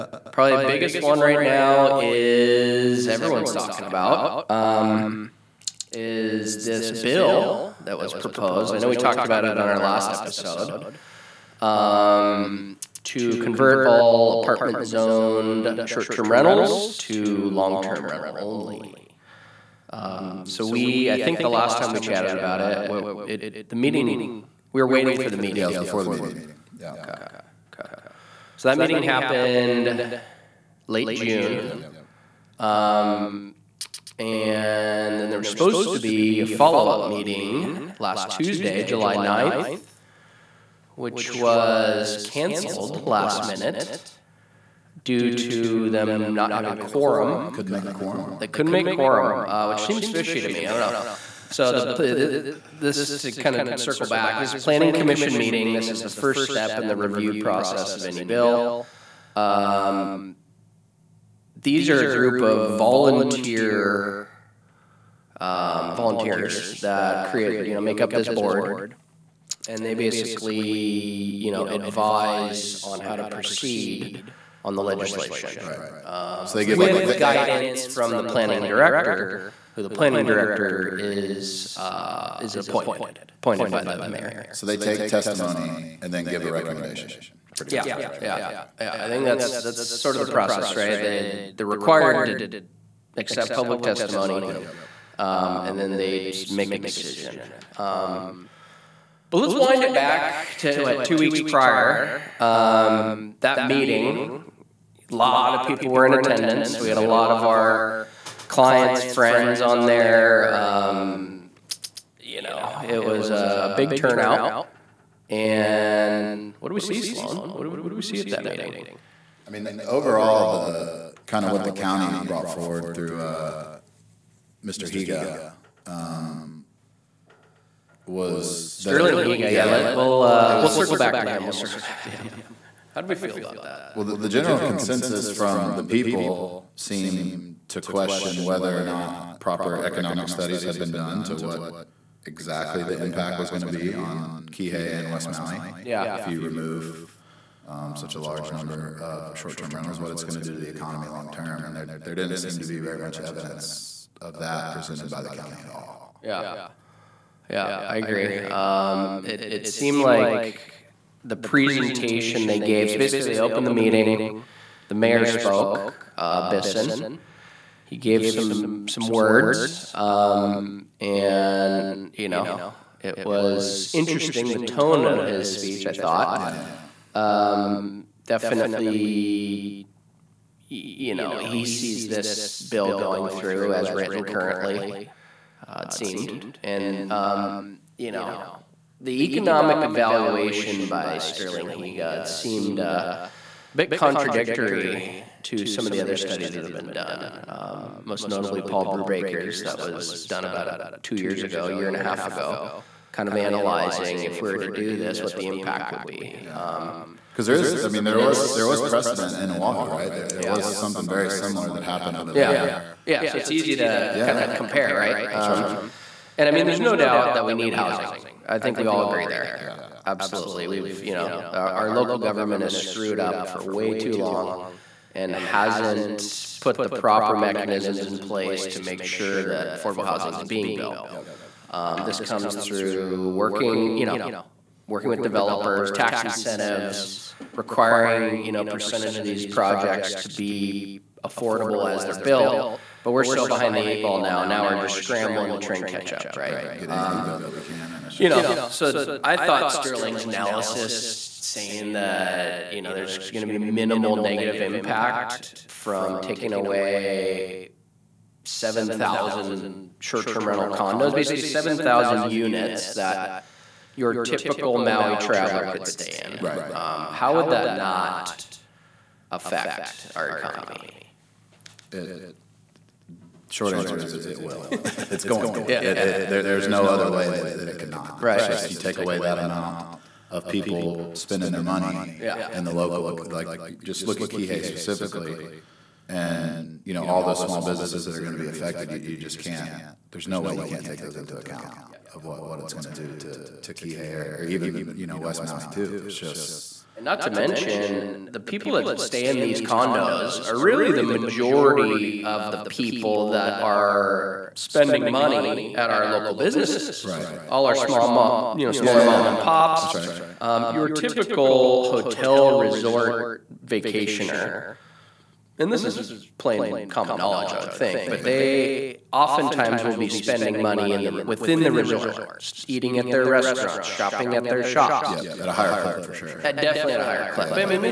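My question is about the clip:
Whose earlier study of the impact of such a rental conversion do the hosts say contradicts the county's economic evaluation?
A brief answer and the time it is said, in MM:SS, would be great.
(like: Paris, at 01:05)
Paul Brewbaker, at 03:18.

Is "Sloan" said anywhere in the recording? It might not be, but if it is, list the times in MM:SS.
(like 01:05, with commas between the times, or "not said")
01:57.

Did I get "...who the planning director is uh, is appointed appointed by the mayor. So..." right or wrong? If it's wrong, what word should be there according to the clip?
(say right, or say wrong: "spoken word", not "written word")
right.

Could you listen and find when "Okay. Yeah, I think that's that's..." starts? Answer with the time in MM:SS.
01:28.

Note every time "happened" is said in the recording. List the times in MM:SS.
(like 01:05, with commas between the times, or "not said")
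00:29, 03:31.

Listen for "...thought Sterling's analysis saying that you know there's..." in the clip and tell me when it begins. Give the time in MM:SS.
04:09.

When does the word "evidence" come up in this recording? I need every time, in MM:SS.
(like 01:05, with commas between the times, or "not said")
02:33.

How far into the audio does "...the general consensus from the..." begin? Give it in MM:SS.
02:14.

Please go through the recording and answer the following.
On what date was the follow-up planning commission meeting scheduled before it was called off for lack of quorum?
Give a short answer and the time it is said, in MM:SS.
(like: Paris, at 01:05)
July 9th, at 00:38.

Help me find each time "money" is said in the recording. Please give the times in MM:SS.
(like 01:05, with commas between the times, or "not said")
04:41, 05:05, 05:20.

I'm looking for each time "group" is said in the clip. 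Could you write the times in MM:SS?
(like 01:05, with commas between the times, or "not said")
01:02.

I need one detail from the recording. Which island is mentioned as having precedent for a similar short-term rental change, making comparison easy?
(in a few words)
Oahu.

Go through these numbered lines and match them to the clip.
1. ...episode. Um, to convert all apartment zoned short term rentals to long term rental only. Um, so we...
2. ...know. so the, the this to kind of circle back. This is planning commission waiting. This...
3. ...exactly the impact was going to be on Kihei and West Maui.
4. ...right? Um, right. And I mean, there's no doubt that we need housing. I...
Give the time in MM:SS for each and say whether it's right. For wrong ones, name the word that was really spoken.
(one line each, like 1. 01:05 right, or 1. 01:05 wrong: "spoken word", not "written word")
1. 00:10 right
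2. 00:50 wrong: "meeting", not "waiting"
3. 02:22 right
4. 03:34 right.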